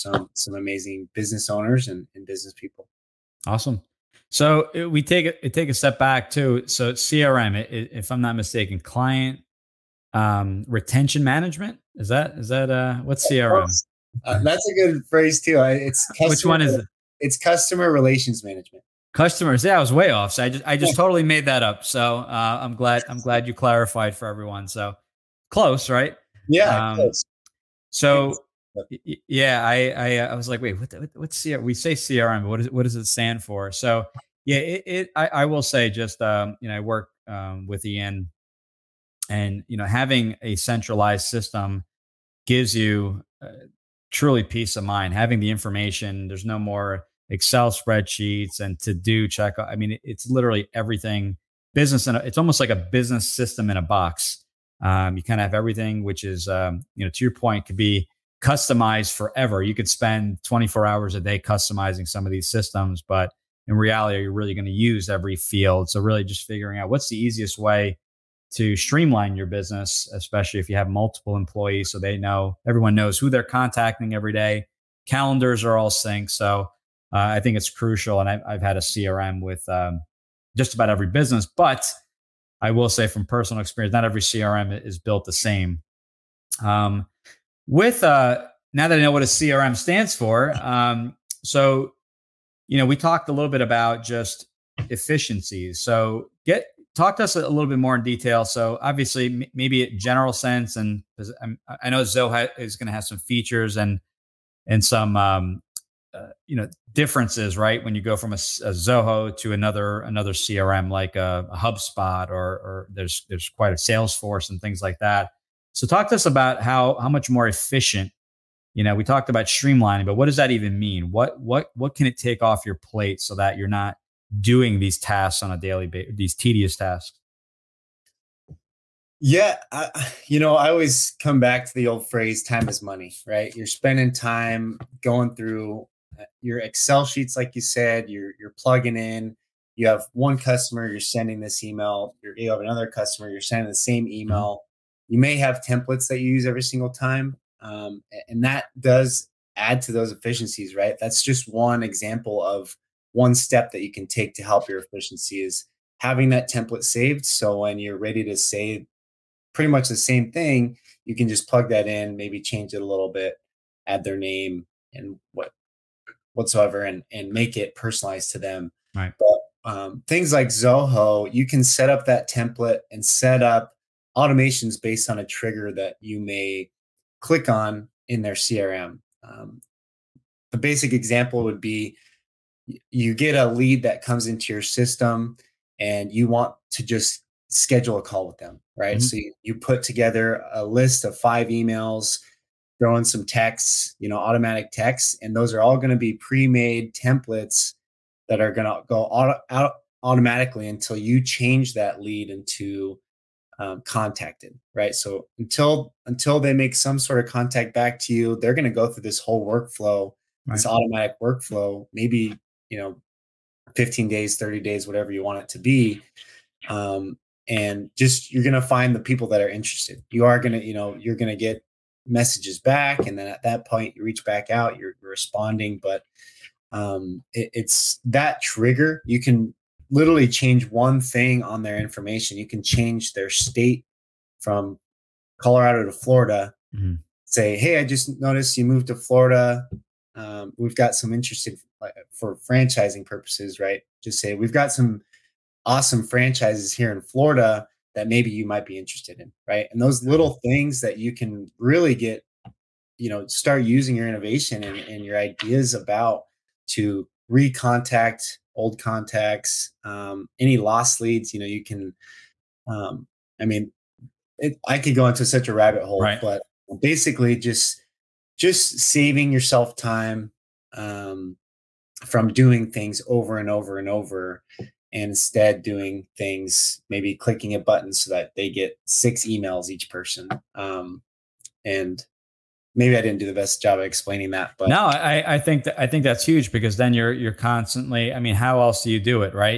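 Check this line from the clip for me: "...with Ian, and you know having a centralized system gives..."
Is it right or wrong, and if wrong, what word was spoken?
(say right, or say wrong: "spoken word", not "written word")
right.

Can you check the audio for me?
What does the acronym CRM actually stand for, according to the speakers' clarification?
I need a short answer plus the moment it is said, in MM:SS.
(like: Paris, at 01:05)
customer relations management, at 00:17.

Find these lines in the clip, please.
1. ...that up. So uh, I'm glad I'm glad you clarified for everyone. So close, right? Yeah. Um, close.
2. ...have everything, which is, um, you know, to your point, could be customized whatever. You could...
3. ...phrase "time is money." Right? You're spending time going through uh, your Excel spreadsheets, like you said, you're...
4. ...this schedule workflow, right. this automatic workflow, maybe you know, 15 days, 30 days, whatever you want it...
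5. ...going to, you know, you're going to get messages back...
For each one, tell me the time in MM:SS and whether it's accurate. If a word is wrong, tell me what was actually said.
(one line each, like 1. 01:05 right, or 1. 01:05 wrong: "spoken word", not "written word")
1. 00:21 right
2. 00:55 wrong: "forever", not "whatever"
3. 02:12 wrong: "sheets", not "spreadsheets"
4. 03:29 wrong: "whole", not "schedule"
5. 03:40 right.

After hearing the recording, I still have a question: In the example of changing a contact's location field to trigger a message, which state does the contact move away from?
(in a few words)
Colorado.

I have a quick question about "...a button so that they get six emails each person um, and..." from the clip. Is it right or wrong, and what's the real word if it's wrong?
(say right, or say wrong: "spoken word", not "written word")
right.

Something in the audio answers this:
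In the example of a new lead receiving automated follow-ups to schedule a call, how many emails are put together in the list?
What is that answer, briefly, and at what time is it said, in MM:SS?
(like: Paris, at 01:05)
5, at 03:11.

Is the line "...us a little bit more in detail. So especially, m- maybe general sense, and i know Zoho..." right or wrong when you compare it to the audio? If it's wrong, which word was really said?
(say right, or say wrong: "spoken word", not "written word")
wrong: "obviously", not "especially".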